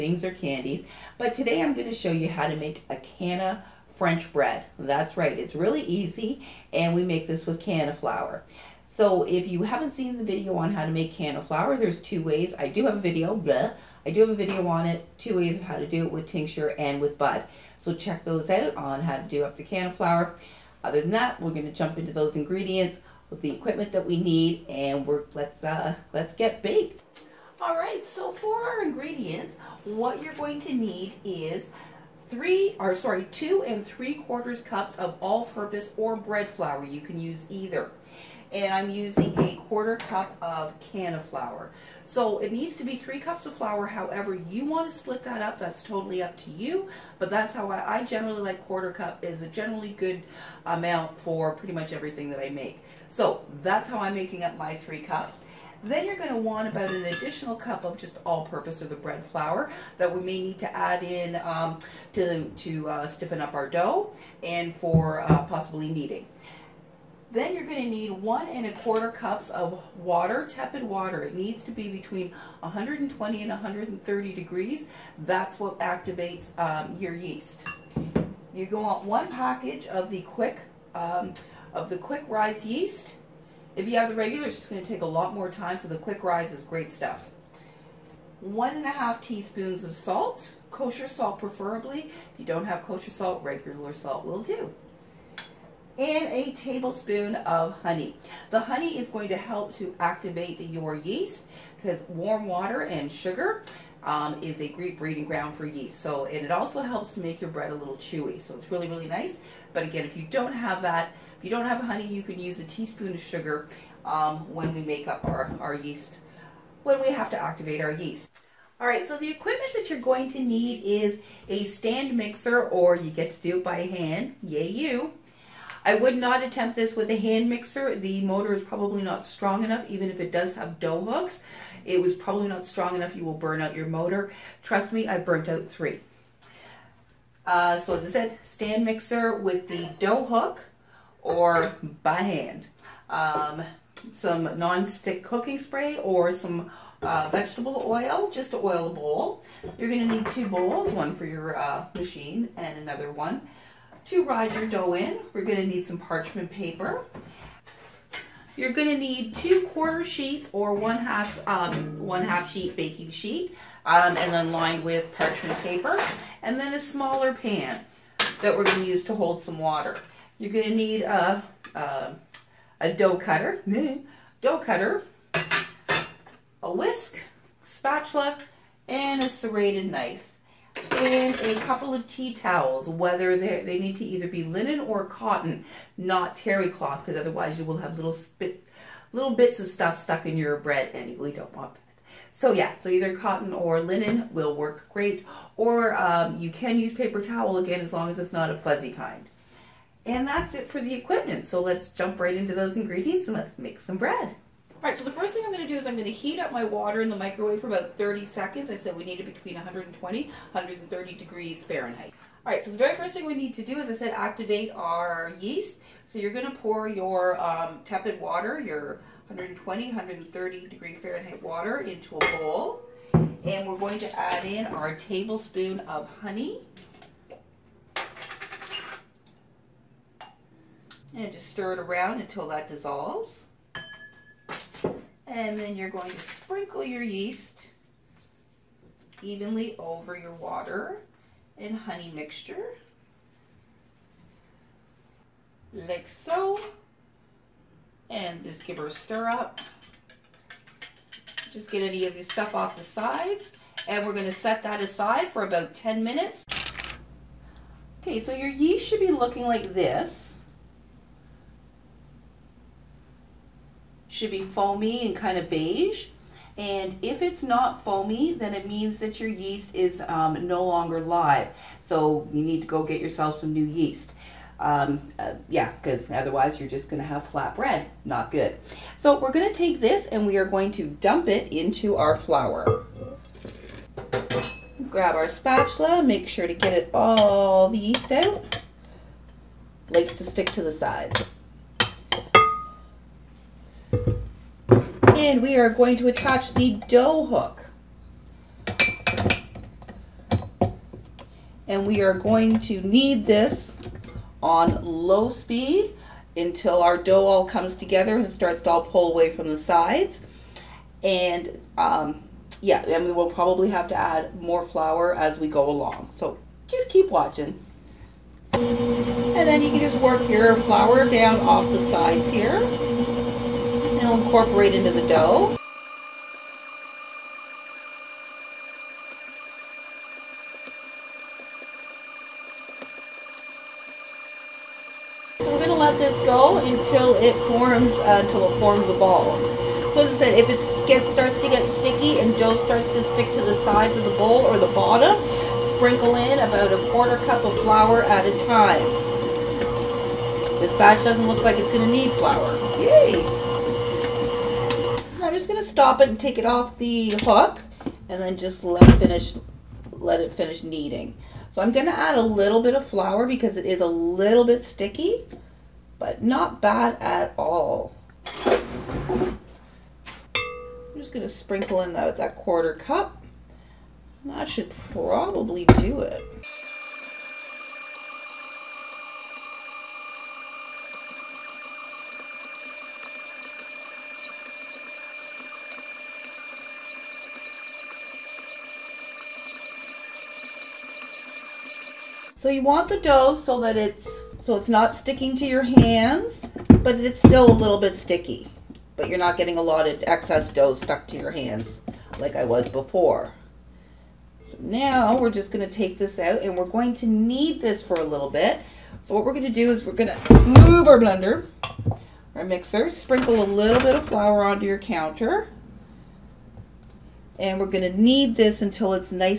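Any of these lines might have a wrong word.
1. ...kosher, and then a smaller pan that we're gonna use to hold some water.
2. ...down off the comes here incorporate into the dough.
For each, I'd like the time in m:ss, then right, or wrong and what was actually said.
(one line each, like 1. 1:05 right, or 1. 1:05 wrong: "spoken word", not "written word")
1. 2:45 wrong: "paper", not "kosher"
2. 5:21 wrong: "sides", not "comes".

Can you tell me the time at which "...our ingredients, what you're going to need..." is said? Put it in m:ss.
0:28.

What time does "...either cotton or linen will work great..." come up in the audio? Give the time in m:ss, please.
3:12.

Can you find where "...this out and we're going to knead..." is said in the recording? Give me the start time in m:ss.
6:45.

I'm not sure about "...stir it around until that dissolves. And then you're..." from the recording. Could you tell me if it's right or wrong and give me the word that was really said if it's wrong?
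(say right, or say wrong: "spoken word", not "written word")
right.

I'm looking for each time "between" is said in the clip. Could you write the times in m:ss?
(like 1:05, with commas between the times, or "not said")
1:11, 3:29.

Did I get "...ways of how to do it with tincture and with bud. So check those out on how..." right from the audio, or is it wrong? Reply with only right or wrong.
right.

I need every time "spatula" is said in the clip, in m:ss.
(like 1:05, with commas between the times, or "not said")
2:57, 4:45.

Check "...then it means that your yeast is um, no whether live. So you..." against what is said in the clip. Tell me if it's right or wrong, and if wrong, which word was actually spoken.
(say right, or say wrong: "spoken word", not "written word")
wrong: "longer", not "whether".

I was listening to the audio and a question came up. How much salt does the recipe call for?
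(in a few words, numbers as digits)
1.5 teaspoons.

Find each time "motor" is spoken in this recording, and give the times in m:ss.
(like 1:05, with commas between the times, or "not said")
2:08, 2:13.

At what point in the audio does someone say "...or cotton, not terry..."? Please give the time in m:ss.
3:04.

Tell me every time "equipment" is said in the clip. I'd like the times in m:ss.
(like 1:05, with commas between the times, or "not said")
0:23, 1:59, 3:20.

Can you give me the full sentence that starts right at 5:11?
And um, yeah, and we will probably have to add more flour as we go along.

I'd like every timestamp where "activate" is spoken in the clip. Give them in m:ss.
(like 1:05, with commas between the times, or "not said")
1:15, 1:39, 1:57, 3:34.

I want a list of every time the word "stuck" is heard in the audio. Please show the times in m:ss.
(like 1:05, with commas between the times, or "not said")
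3:10, 6:40.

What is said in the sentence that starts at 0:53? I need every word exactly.
So that's how I'm making up my three cups.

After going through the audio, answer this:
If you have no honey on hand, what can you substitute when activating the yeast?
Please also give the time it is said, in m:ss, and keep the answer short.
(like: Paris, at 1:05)
a teaspoon of sugar, at 1:52.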